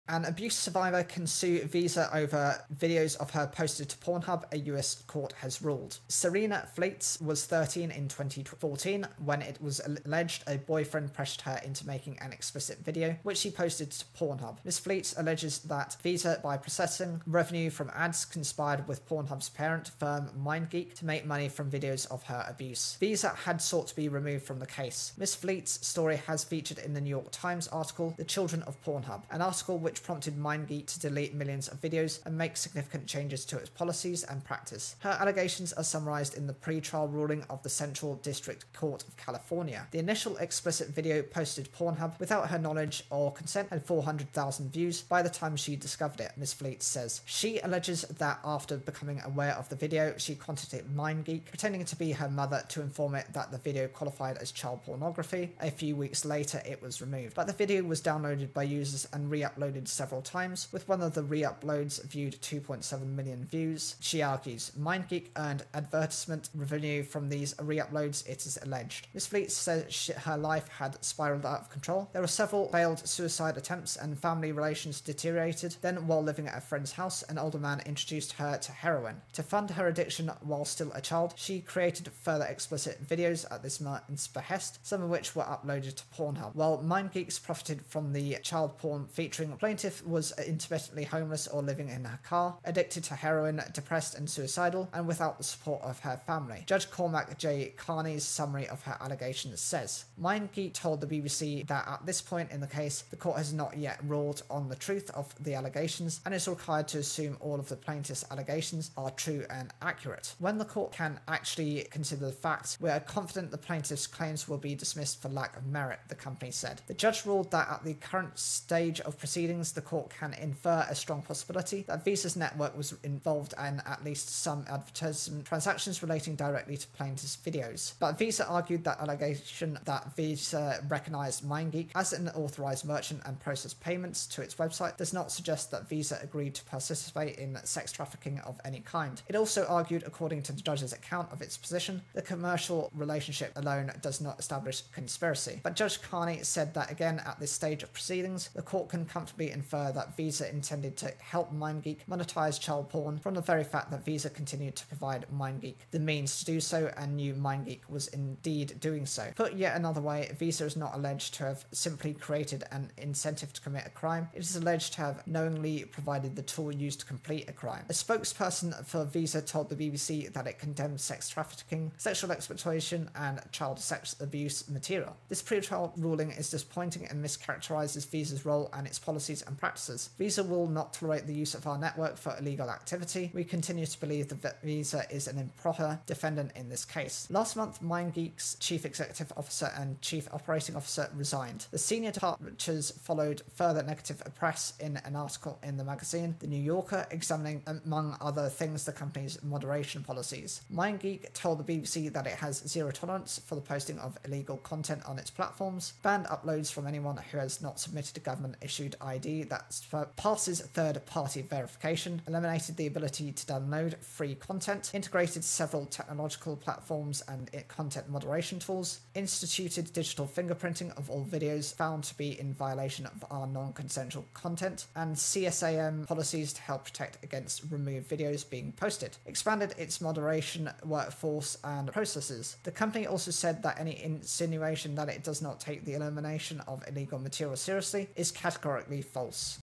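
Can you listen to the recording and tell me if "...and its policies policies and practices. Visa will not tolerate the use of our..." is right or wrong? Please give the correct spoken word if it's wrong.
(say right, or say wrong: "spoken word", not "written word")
right.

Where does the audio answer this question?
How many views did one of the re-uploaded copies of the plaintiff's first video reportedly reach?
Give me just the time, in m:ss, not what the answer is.
1:02.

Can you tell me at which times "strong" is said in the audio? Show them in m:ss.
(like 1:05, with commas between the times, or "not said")
2:00.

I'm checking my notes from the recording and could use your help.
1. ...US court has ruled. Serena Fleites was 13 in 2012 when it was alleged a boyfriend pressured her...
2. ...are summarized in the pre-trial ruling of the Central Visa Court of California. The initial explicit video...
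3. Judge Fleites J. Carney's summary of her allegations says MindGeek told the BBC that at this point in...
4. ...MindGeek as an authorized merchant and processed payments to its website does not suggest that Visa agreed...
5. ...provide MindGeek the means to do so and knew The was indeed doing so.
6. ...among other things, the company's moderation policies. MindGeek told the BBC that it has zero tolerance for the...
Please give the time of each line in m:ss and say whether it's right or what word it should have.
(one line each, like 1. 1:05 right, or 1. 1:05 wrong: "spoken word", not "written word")
1. 0:04 wrong: "2014", not "2012"
2. 0:35 wrong: "District", not "Visa"
3. 1:36 wrong: "Cormac", not "Fleites"
4. 2:11 right
5. 2:34 wrong: "MindGeek", not "The"
6. 3:17 right.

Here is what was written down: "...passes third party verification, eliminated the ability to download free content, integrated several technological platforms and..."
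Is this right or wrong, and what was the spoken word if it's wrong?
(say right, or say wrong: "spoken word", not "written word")
right.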